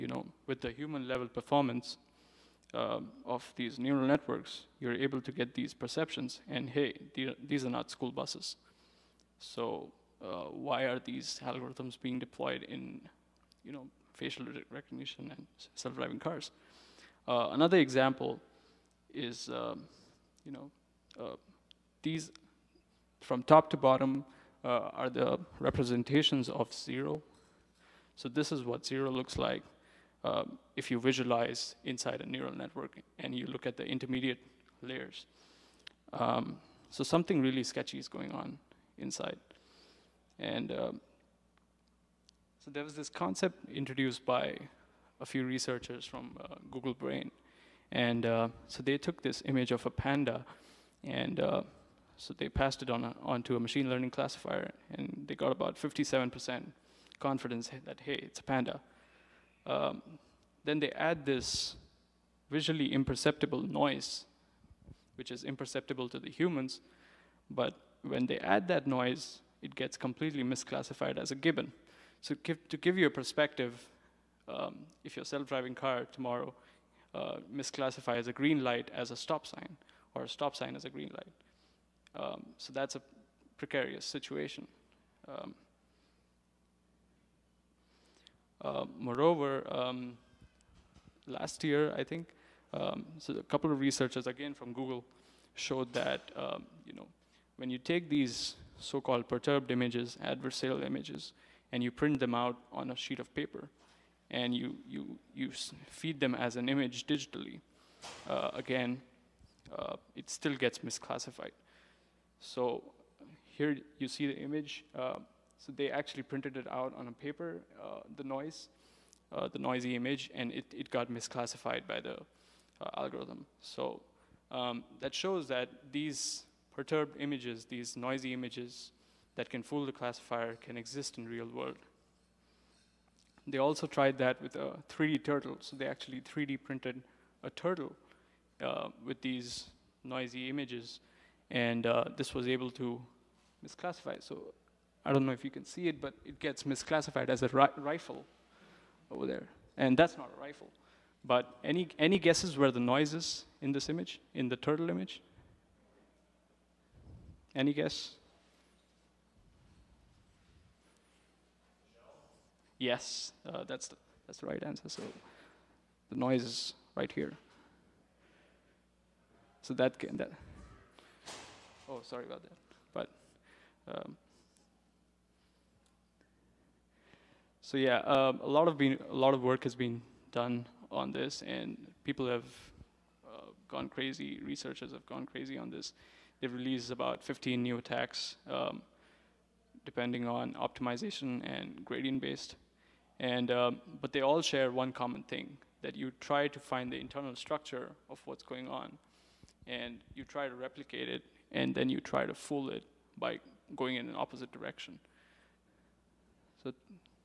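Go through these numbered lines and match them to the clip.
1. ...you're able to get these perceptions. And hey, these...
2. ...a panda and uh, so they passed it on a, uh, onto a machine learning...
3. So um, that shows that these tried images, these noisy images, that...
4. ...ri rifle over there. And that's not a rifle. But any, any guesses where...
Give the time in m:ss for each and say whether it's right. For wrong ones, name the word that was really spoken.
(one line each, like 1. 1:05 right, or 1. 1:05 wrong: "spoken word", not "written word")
1. 0:04 right
2. 0:49 right
3. 2:03 wrong: "perturbed", not "tried"
4. 2:27 right.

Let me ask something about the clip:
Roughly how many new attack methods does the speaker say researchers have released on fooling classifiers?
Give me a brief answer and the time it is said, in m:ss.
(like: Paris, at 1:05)
15, at 3:07.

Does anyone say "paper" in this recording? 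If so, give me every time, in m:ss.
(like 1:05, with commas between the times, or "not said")
1:43, 1:57.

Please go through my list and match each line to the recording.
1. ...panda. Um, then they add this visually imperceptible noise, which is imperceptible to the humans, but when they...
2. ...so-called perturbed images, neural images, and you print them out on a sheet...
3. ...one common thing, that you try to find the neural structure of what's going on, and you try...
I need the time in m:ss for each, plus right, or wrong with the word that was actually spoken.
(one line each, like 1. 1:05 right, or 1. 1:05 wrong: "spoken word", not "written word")
1. 0:58 right
2. 1:38 wrong: "adversarial", not "neural"
3. 3:14 wrong: "internal", not "neural".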